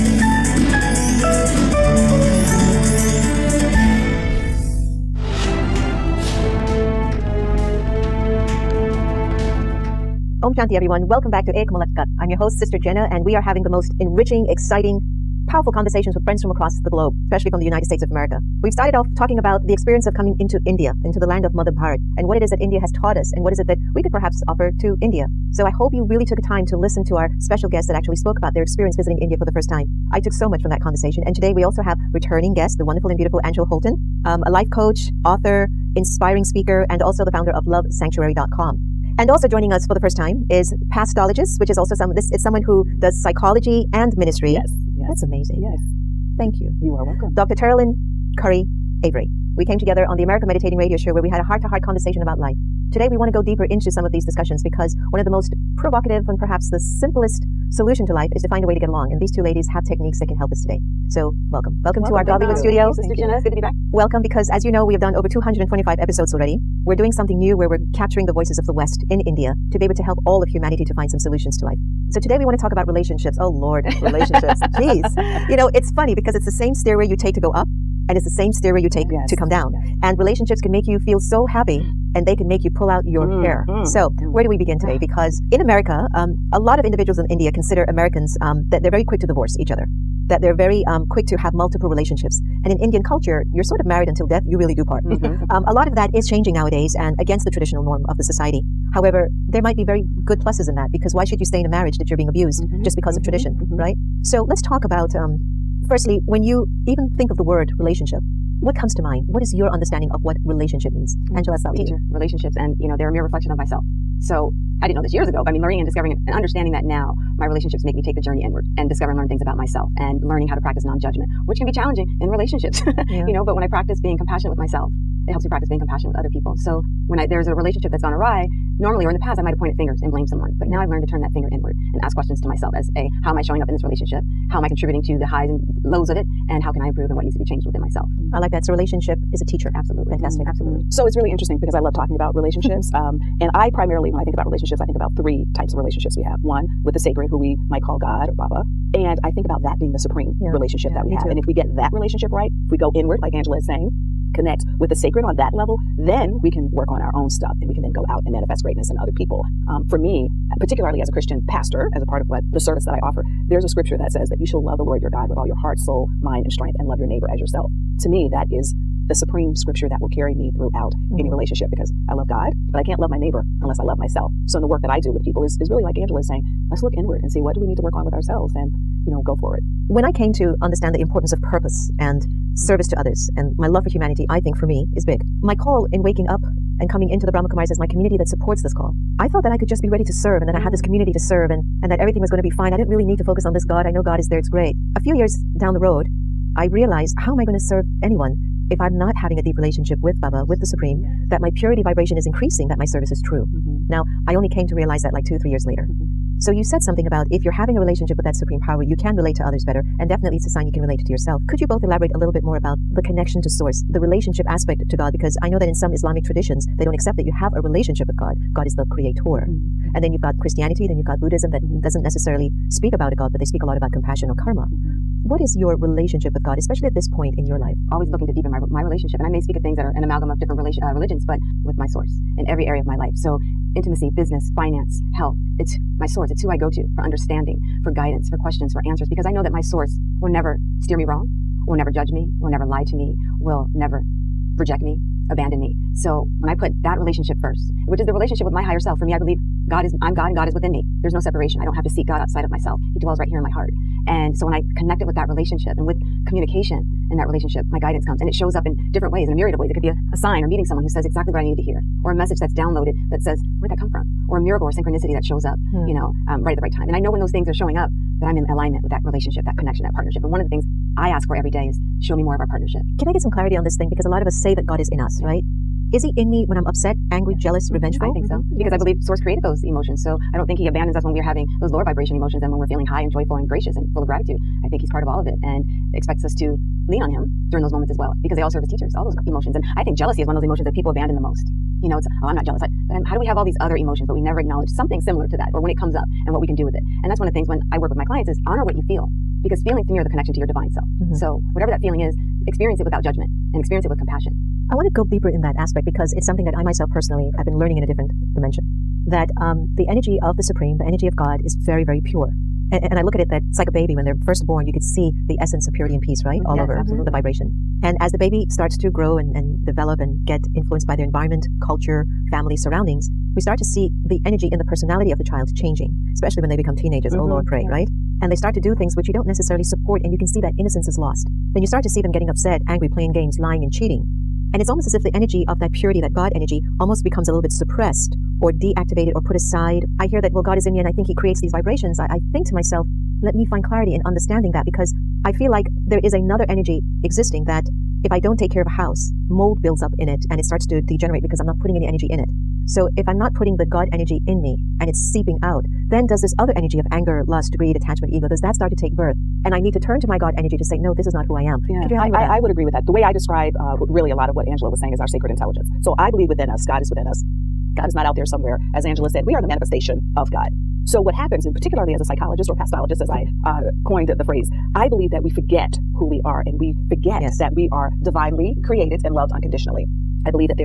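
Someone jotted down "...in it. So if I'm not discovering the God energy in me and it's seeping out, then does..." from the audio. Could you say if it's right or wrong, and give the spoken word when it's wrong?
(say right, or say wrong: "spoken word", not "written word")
wrong: "putting", not "discovering".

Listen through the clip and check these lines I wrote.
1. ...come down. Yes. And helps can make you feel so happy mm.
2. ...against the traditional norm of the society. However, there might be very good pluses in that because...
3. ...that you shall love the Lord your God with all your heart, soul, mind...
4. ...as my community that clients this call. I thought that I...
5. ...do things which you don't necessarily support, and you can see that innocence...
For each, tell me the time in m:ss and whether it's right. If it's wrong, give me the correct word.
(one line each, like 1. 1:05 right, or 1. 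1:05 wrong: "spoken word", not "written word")
1. 1:19 wrong: "relationships", not "helps"
2. 1:37 right
3. 2:44 right
4. 3:07 wrong: "supports", not "clients"
5. 5:28 right.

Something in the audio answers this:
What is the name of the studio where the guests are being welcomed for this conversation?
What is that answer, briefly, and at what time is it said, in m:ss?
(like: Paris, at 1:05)
Godlywood studio, at 1:02.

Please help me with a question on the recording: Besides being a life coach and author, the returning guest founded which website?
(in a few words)
lovesanctuary.com.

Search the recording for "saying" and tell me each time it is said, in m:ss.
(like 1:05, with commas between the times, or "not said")
2:33, 2:56, 6:04.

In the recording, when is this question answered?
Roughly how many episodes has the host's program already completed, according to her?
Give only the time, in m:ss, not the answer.
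1:05.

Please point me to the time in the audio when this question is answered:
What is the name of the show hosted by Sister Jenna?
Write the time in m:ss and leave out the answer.
0:11.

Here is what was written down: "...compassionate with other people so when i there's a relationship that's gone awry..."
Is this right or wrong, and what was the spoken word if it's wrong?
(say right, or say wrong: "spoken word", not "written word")
right.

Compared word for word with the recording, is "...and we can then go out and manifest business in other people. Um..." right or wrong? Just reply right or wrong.
wrong.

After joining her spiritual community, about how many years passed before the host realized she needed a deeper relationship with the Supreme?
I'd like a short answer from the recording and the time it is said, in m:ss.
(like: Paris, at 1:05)
2 to 3 years, at 3:25.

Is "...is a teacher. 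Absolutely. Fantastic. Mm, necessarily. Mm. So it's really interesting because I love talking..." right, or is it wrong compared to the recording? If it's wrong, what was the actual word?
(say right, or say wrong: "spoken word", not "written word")
wrong: "absolutely", not "necessarily".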